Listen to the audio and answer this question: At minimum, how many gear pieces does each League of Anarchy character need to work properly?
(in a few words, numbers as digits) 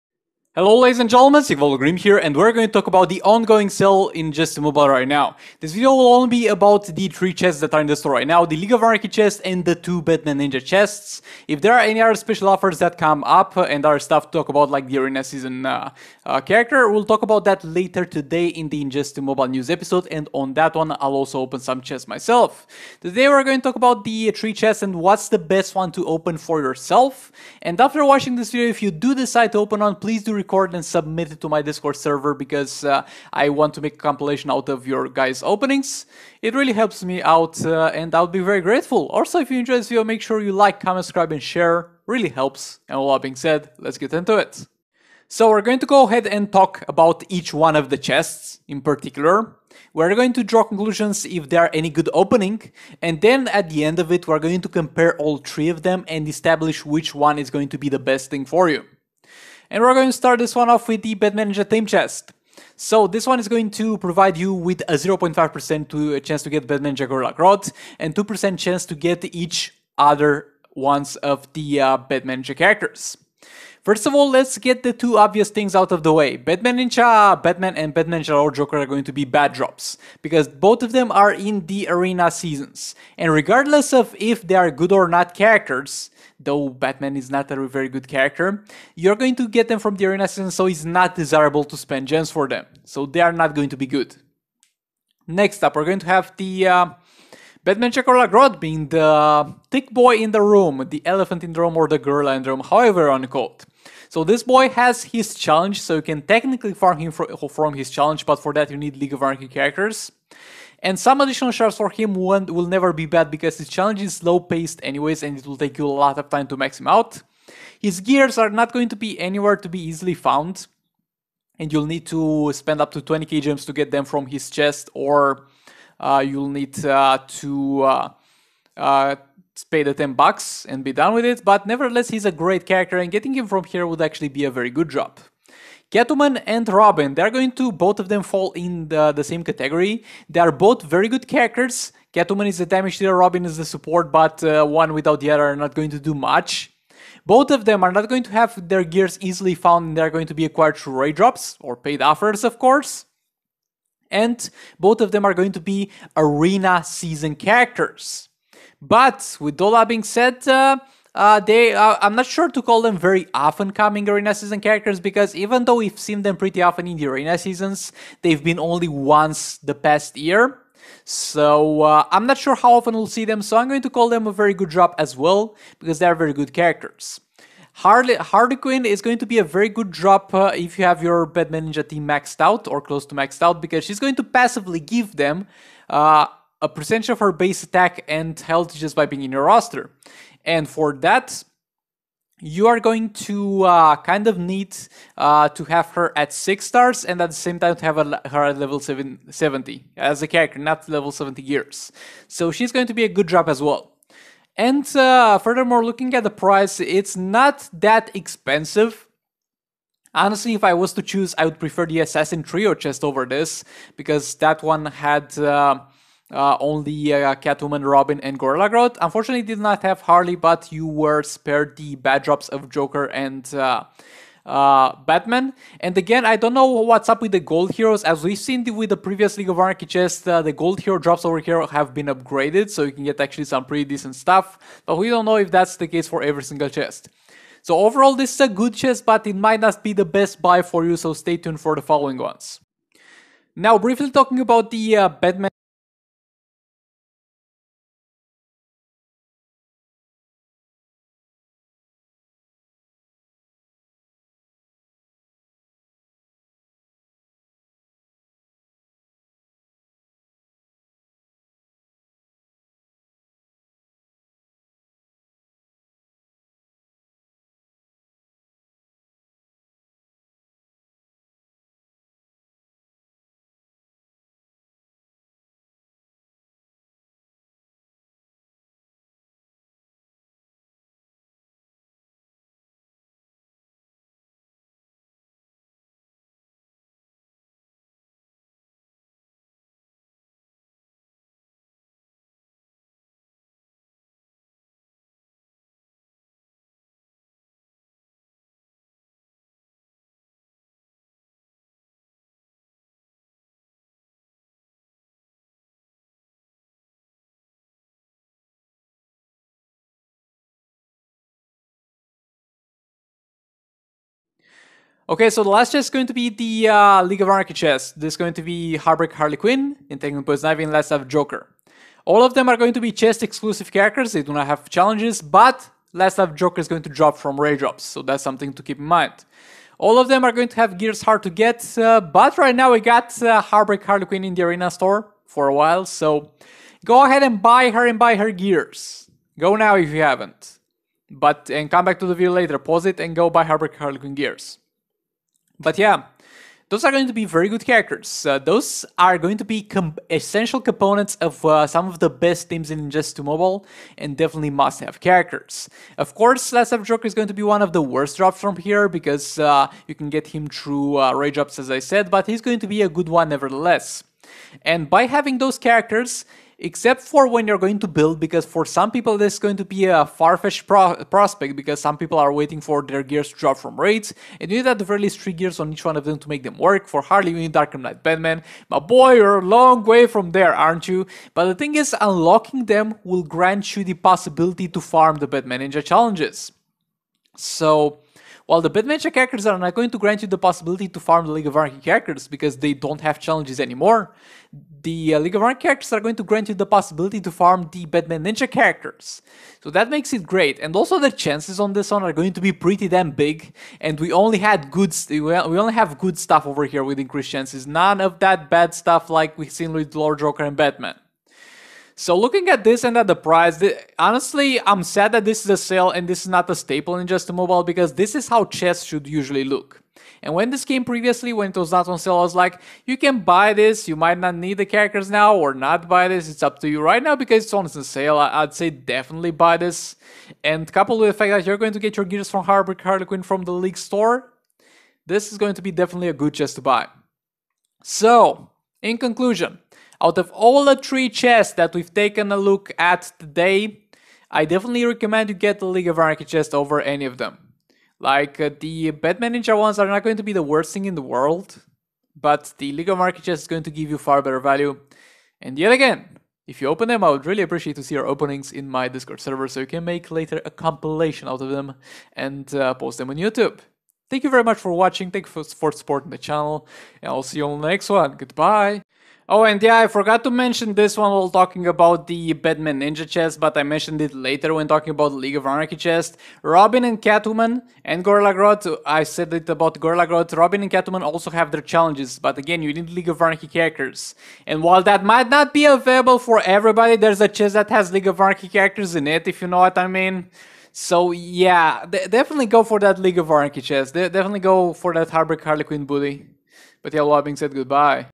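3.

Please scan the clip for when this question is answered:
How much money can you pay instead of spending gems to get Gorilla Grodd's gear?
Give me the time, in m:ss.
2:09.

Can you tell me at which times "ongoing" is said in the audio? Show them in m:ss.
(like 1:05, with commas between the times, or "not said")
0:03.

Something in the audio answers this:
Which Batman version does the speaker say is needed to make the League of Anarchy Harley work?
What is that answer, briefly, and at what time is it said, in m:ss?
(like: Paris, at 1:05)
Dark Knight Batman, at 6:17.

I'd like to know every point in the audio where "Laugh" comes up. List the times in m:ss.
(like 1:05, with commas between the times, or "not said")
5:20, 5:26, 5:56.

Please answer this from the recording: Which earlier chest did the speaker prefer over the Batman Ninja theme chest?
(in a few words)
Assassin Trio chest.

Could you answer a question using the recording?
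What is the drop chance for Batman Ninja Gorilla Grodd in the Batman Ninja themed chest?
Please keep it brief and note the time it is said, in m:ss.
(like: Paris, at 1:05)
0.5%, at 1:04.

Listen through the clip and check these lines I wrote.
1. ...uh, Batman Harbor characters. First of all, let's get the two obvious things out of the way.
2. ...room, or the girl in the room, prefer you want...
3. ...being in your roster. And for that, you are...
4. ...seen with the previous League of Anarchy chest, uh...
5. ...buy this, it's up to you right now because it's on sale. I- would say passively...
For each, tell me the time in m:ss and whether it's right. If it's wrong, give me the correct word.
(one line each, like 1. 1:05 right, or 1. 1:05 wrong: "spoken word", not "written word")
1. 1:11 wrong: "Ninja", not "Harbor"
2. 1:41 wrong: "however", not "prefer"
3. 3:09 right
4. 3:48 right
5. 7:05 wrong: "definitely", not "passively".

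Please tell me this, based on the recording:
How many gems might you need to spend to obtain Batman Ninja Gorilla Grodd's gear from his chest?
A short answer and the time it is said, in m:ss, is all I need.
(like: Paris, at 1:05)
20k, at 2:02.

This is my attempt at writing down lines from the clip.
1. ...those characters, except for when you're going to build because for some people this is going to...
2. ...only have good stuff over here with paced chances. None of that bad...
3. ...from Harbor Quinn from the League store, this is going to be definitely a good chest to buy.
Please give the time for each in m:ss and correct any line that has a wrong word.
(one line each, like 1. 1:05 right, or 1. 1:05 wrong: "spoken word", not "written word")
1. 6:05 right
2. 6:45 wrong: "increased", not "paced"
3. 7:12 right.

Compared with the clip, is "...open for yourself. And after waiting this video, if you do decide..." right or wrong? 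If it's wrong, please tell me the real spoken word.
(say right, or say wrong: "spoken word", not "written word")
wrong: "watching", not "waiting".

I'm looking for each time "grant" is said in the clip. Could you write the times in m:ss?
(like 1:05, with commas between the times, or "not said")
6:23, 6:29, 6:36.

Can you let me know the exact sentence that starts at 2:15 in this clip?
Catwoman and Robin, they're going to both of them fall in the, the same category.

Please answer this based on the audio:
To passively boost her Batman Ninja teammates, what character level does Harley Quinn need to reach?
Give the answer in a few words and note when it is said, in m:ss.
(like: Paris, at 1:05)
70, at 3:18.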